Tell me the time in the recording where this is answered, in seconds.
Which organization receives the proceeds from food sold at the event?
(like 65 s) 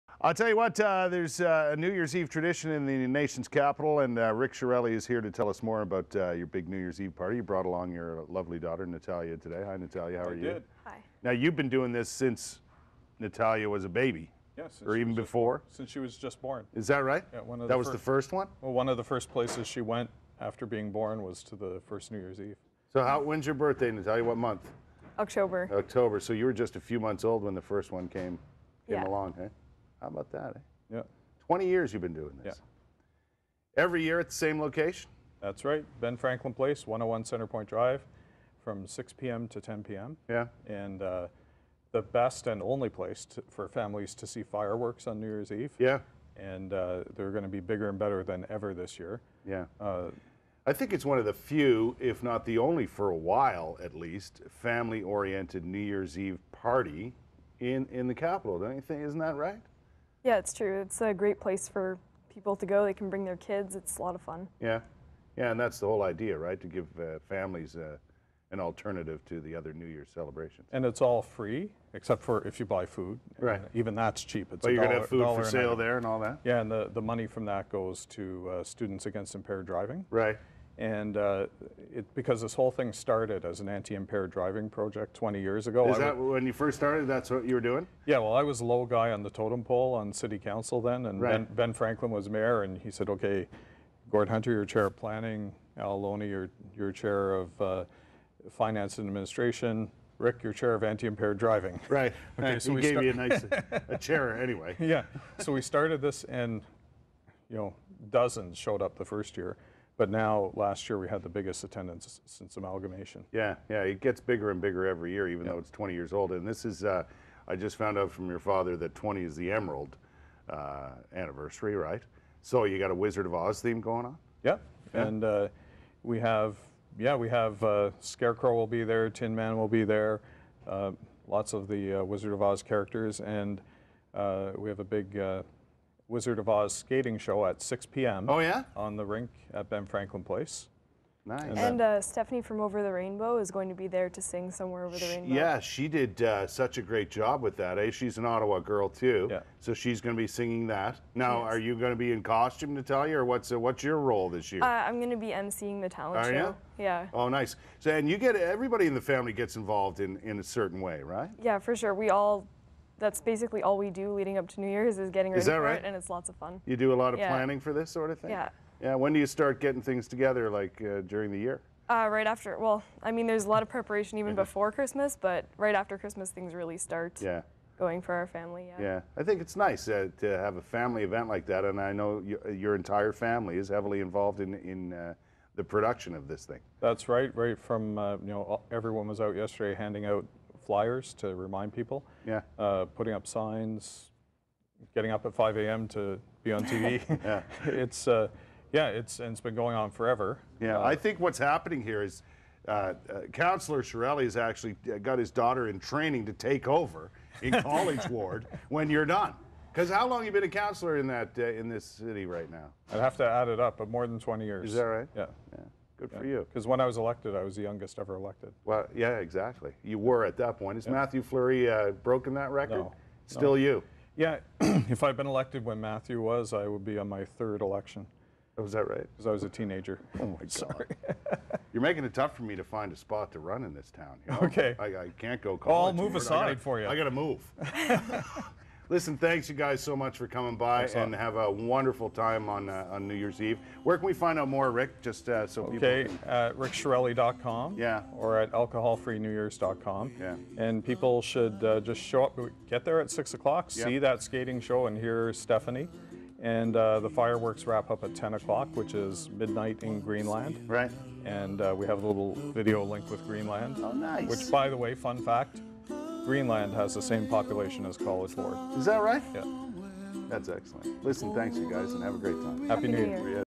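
78 s.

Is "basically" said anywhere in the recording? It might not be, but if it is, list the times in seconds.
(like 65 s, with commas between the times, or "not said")
163 s.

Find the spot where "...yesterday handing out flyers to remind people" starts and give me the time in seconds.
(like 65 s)
189 s.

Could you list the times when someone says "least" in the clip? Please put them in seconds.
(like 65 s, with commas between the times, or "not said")
53 s.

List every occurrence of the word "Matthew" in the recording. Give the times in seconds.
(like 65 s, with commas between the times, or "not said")
220 s, 225 s.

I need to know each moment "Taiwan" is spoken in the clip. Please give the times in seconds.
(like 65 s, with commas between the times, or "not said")
not said.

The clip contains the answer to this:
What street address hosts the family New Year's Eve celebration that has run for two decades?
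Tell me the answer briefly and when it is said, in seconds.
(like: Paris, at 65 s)
101 Centrepointe Drive, at 36 s.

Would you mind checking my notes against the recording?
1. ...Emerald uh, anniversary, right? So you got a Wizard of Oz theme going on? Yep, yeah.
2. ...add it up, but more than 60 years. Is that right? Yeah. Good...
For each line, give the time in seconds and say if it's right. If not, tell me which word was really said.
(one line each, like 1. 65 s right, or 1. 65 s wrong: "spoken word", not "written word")
1. 119 s right
2. 213 s wrong: "20", not "60".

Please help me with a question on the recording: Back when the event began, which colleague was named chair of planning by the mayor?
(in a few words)
Gord Hunter.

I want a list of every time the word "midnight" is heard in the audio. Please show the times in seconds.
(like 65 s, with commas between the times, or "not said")
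259 s.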